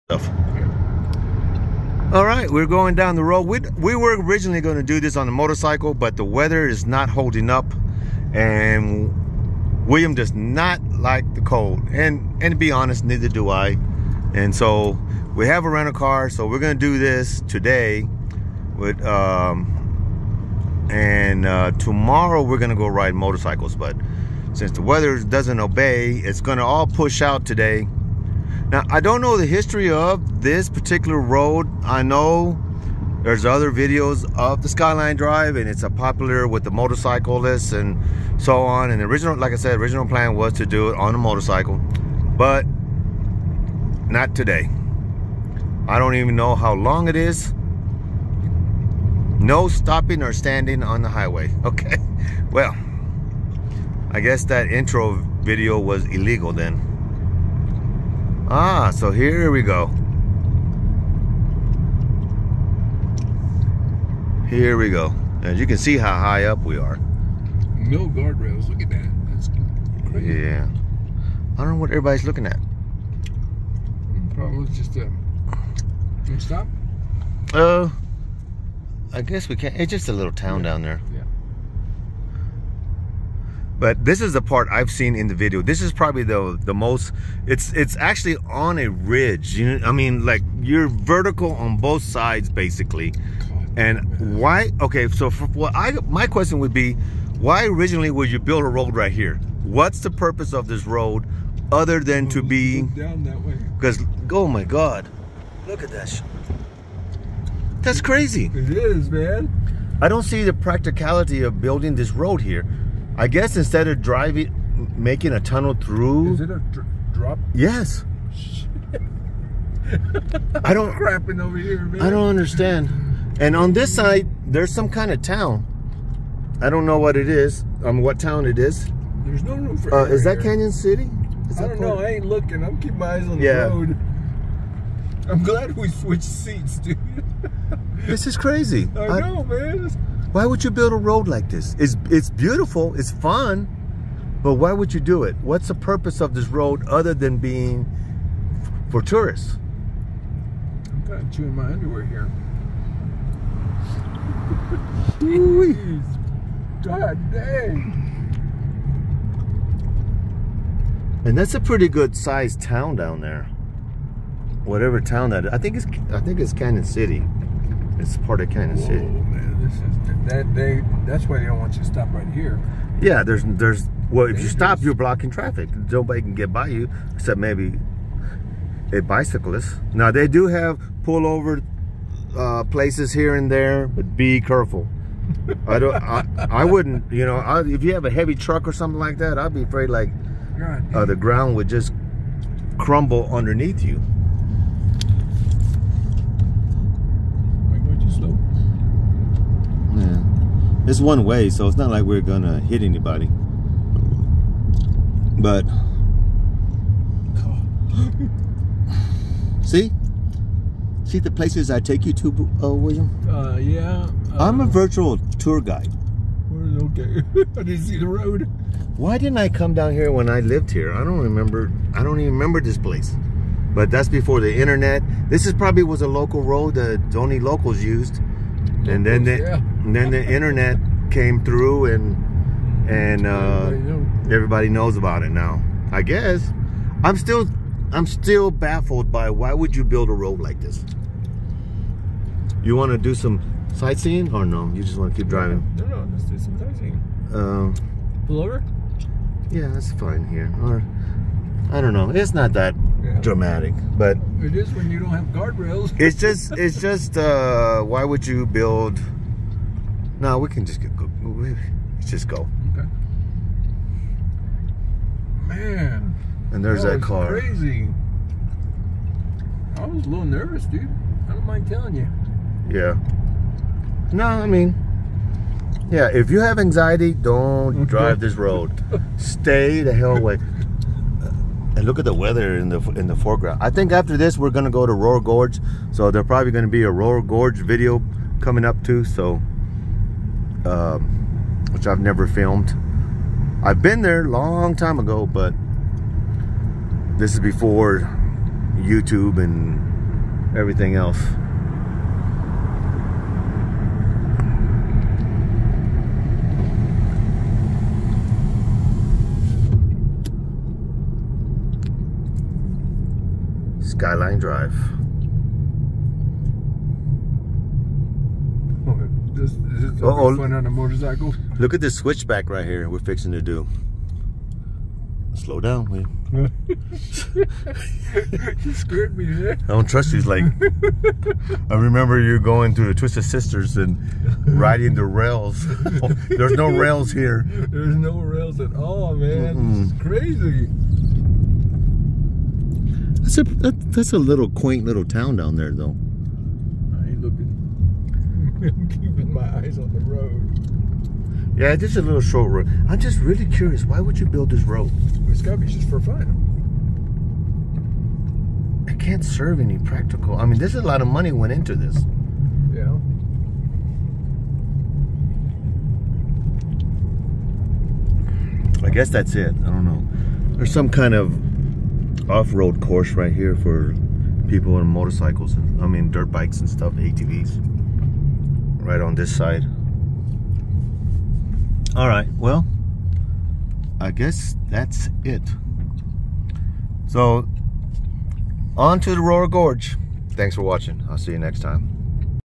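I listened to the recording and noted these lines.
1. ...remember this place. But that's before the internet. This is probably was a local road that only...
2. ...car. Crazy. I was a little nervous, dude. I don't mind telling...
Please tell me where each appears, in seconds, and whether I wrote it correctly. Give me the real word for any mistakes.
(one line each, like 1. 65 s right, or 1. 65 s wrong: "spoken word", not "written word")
1. 222 s right
2. 267 s right.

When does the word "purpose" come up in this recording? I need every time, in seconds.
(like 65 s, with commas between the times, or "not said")
100 s, 145 s.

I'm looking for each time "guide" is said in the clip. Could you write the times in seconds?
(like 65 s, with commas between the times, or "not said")
215 s.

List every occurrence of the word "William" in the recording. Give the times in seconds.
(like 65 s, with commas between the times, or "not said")
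9 s, 212 s.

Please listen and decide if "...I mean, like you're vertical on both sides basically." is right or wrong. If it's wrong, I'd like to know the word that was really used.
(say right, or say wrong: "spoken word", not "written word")
right.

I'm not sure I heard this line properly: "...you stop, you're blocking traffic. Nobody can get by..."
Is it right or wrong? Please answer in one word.
right.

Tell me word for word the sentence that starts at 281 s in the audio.
And look at the weather in the in the foreground.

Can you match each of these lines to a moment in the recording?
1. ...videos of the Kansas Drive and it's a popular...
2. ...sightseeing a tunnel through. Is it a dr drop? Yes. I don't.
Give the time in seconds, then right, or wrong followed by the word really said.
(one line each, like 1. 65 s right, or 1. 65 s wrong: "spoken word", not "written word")
1. 33 s wrong: "Skyline", not "Kansas"
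2. 114 s wrong: "making", not "sightseeing".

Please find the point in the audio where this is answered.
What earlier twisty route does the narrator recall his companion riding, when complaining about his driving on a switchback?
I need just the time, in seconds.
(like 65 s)
332 s.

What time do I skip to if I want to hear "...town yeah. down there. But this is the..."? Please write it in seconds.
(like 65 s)
80 s.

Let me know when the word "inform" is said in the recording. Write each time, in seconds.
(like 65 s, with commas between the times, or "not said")
not said.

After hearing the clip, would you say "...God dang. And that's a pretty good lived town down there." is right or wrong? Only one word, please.
wrong.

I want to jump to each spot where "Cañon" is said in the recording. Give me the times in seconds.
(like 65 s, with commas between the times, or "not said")
130 s, 166 s.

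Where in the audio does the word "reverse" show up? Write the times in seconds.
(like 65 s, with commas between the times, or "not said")
not said.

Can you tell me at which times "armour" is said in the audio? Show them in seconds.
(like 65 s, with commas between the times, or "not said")
not said.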